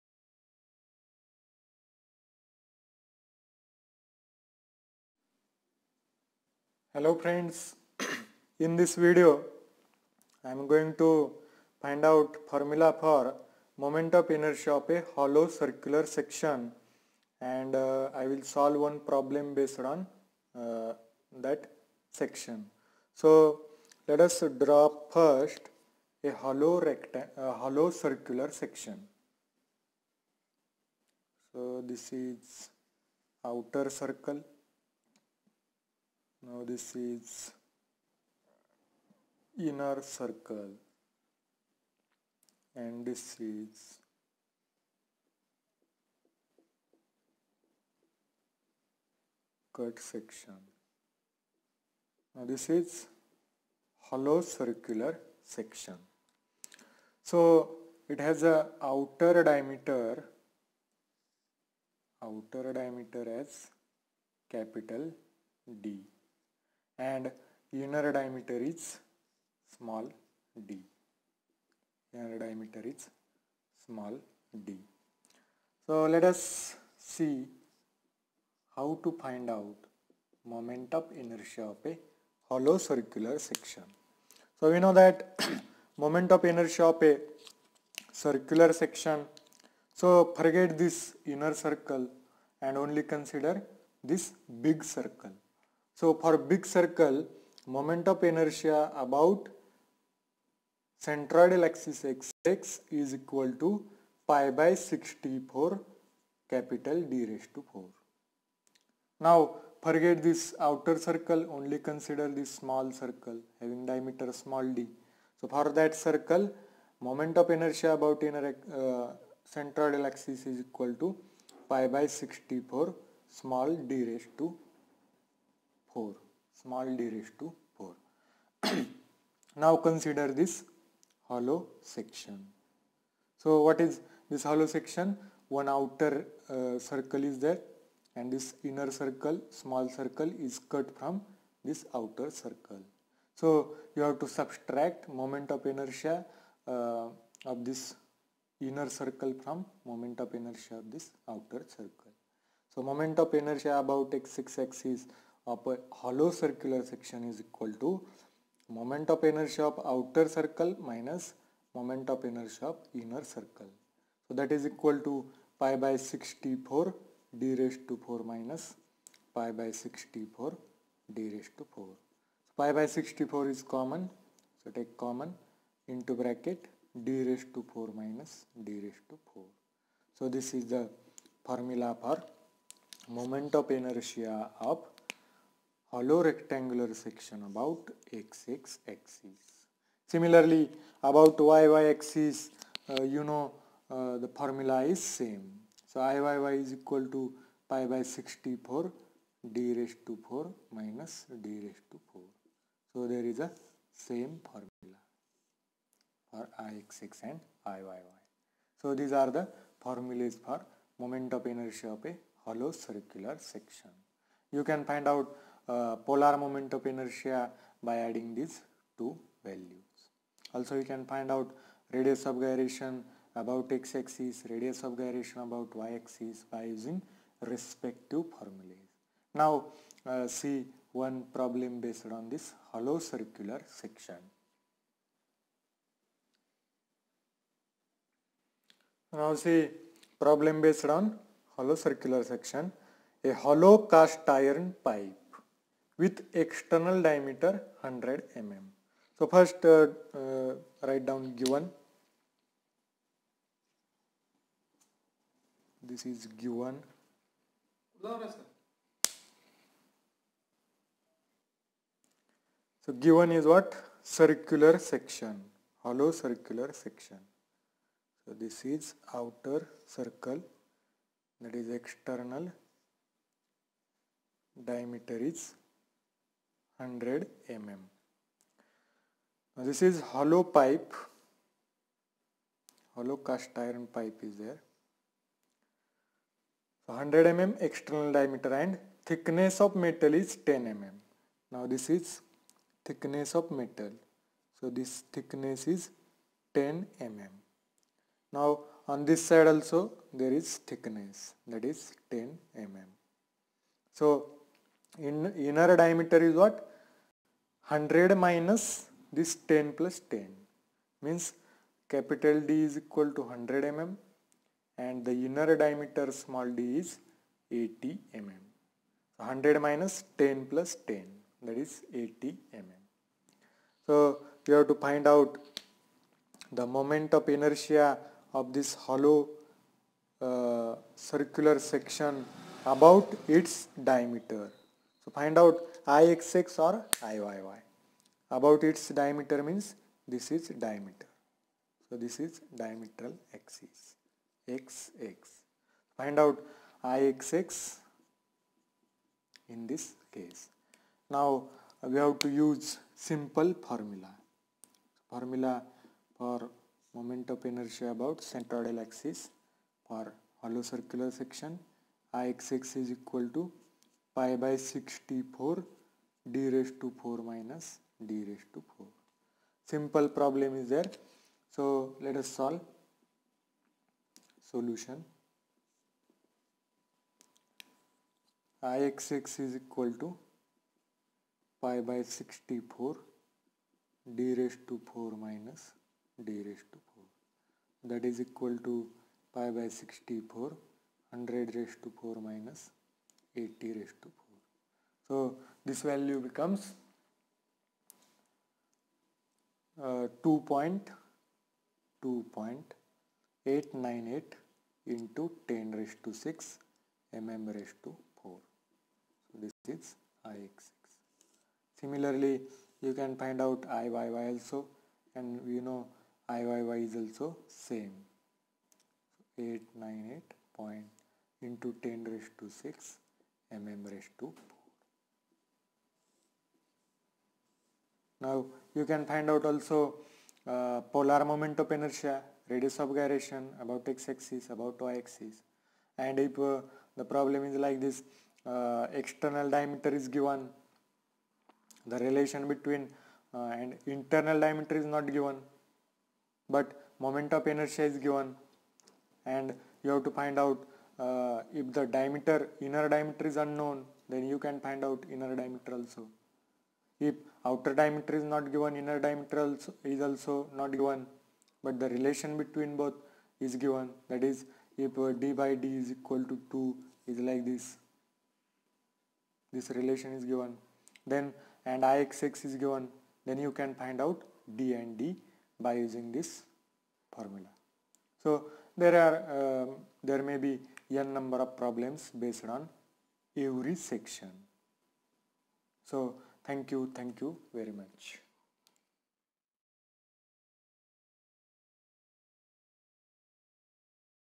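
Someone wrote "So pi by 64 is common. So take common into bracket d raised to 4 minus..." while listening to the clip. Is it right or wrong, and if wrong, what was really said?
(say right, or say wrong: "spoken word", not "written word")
right.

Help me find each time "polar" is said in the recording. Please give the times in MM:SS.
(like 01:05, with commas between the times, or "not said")
03:36, 07:10.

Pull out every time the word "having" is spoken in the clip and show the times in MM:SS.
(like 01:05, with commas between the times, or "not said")
01:53.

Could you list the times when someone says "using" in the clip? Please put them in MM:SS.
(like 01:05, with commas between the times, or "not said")
03:46, 07:55.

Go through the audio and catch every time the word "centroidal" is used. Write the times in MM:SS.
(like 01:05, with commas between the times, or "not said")
01:41, 01:59, 05:58.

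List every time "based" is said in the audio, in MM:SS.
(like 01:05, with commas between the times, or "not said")
00:19, 03:51, 04:00, 08:02.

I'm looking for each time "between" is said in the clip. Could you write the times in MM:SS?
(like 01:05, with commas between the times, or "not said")
07:22, 07:42.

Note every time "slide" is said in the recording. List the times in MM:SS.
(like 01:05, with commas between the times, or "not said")
not said.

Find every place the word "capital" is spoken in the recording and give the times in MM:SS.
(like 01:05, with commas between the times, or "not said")
01:04, 01:46, 05:11.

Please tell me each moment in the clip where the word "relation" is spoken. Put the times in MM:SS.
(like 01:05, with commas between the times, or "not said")
07:21, 07:41, 07:49.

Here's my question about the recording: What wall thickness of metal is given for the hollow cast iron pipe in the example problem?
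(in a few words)
10 mm.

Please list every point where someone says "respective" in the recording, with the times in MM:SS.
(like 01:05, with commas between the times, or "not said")
03:47.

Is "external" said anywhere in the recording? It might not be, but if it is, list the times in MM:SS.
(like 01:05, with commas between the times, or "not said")
04:06, 04:31, 04:47, 07:18.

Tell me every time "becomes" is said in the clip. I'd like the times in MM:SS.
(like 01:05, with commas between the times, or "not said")
06:36.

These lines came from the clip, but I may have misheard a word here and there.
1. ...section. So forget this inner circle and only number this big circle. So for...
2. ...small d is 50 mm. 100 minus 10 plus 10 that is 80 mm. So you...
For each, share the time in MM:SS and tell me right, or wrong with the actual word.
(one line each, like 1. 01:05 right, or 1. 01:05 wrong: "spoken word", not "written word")
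1. 01:28 wrong: "consider", not "number"
2. 05:16 wrong: "80", not "50".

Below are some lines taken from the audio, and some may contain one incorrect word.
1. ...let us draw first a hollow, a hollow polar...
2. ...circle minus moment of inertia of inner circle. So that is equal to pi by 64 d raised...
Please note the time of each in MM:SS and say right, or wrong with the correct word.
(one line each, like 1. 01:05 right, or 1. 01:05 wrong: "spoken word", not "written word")
1. 00:24 wrong: "circular", not "polar"
2. 02:40 right.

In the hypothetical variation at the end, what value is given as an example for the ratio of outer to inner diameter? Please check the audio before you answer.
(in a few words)
2.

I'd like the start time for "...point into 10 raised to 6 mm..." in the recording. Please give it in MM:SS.
07:00.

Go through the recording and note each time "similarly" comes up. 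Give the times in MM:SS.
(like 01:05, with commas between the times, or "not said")
03:10, 06:51.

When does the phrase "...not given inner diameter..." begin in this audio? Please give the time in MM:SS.
07:38.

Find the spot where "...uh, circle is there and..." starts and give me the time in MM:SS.
02:16.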